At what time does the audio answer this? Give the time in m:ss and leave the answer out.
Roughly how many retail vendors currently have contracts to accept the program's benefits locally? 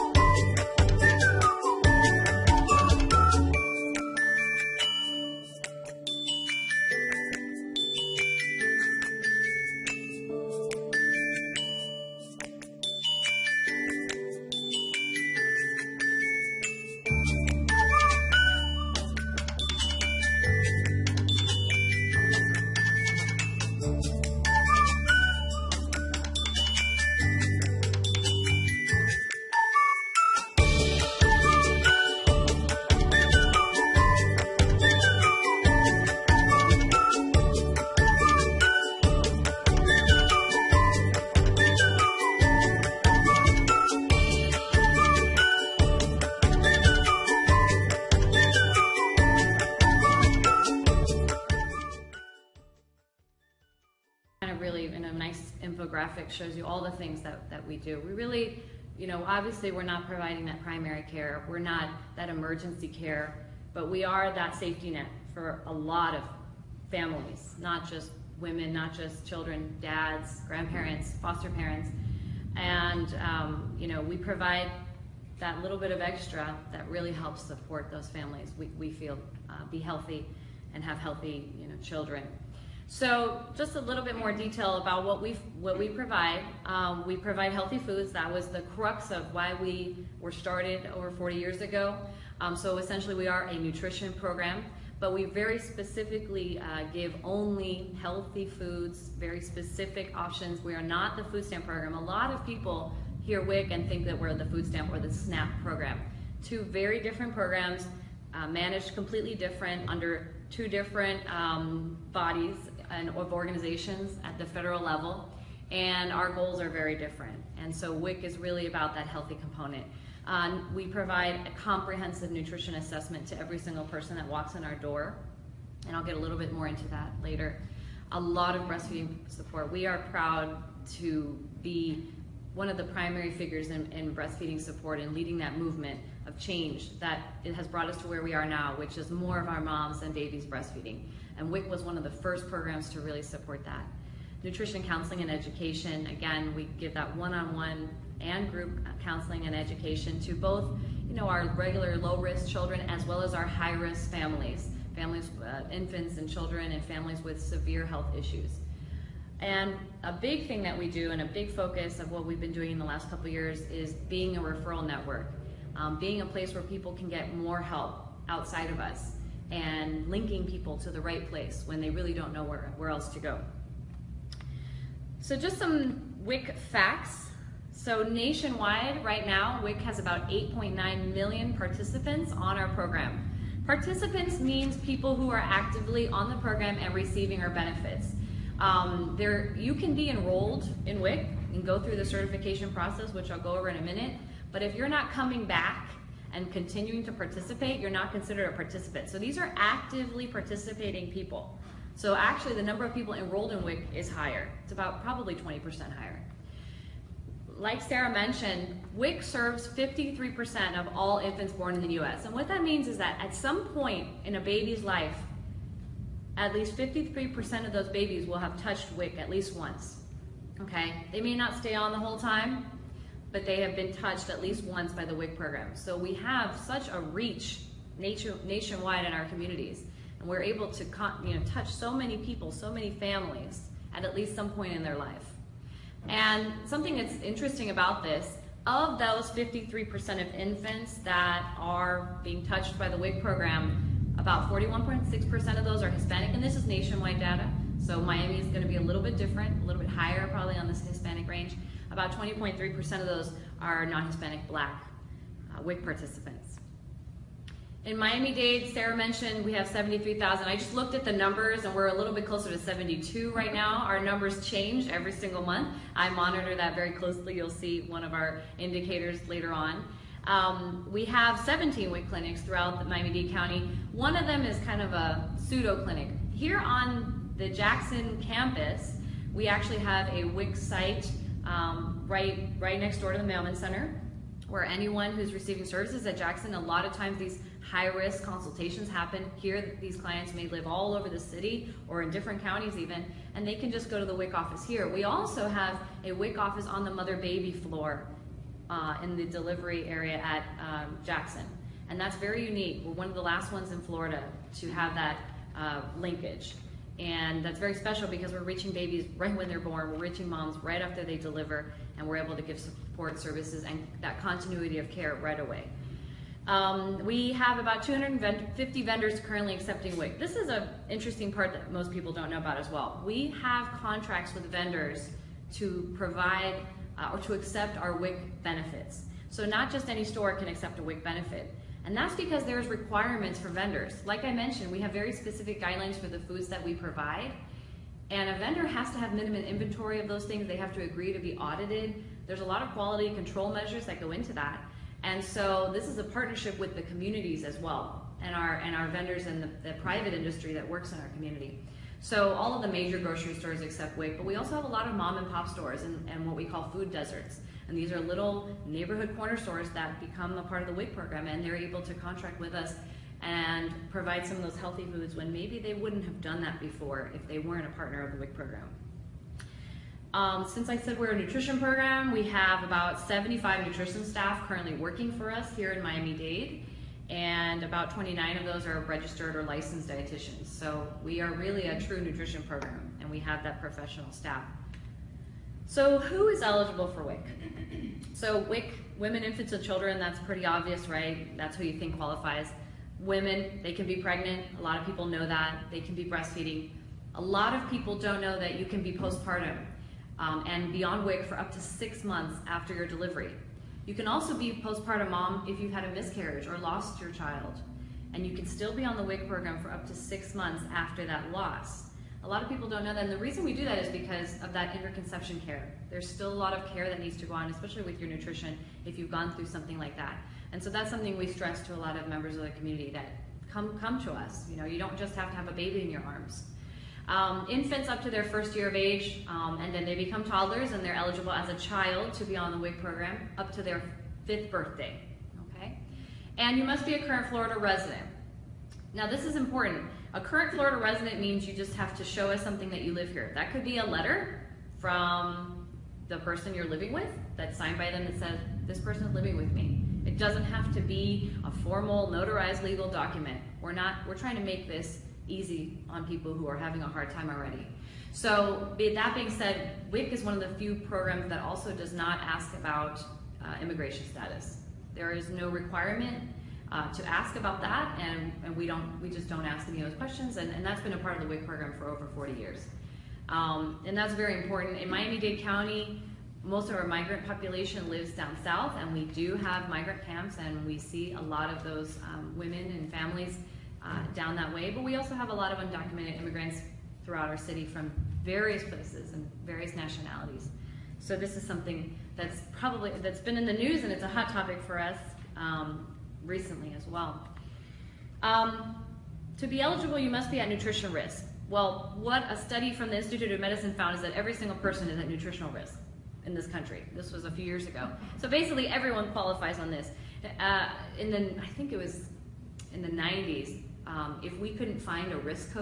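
5:17.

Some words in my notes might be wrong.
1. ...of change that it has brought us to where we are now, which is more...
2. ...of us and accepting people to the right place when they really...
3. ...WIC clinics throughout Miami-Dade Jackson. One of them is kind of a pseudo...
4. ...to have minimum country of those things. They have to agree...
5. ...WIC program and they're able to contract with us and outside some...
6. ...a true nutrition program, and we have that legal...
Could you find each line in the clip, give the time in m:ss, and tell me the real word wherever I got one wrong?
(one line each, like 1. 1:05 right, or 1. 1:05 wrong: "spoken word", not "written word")
1. 2:16 right
2. 2:48 wrong: "linking", not "accepting"
3. 4:31 wrong: "County", not "Jackson"
4. 5:38 wrong: "inventory", not "country"
5. 6:00 wrong: "provide", not "outside"
6. 6:21 wrong: "professional", not "legal".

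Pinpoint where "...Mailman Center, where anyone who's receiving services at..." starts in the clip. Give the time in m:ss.
4:43.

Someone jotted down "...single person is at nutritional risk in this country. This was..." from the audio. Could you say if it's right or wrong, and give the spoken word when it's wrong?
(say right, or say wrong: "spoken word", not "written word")
right.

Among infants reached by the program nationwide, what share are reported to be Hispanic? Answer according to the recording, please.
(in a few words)
41.6%.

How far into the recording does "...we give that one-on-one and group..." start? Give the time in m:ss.
2:26.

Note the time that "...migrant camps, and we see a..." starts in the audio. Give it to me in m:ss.
7:59.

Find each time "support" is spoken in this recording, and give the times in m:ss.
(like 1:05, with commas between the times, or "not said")
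1:17, 2:09, 2:14, 2:23, 5:12.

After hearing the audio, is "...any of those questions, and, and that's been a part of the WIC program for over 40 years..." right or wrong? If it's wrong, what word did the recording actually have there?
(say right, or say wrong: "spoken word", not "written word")
right.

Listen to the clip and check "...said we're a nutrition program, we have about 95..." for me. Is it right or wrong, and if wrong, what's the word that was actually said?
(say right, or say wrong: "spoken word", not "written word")
wrong: "75", not "95".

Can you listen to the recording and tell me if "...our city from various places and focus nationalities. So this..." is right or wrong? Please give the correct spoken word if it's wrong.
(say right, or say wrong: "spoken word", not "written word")
wrong: "various", not "focus".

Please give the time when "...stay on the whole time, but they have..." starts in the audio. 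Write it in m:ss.
3:41.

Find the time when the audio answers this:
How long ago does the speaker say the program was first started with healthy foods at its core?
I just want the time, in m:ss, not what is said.
1:30.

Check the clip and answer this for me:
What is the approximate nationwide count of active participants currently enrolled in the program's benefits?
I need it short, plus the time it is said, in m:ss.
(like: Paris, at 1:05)
8.9 million, at 3:00.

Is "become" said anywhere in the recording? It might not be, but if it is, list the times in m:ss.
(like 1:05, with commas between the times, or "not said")
5:59, 7:09.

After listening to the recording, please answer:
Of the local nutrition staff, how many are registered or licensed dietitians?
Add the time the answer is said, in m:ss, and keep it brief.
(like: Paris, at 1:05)
29, at 6:17.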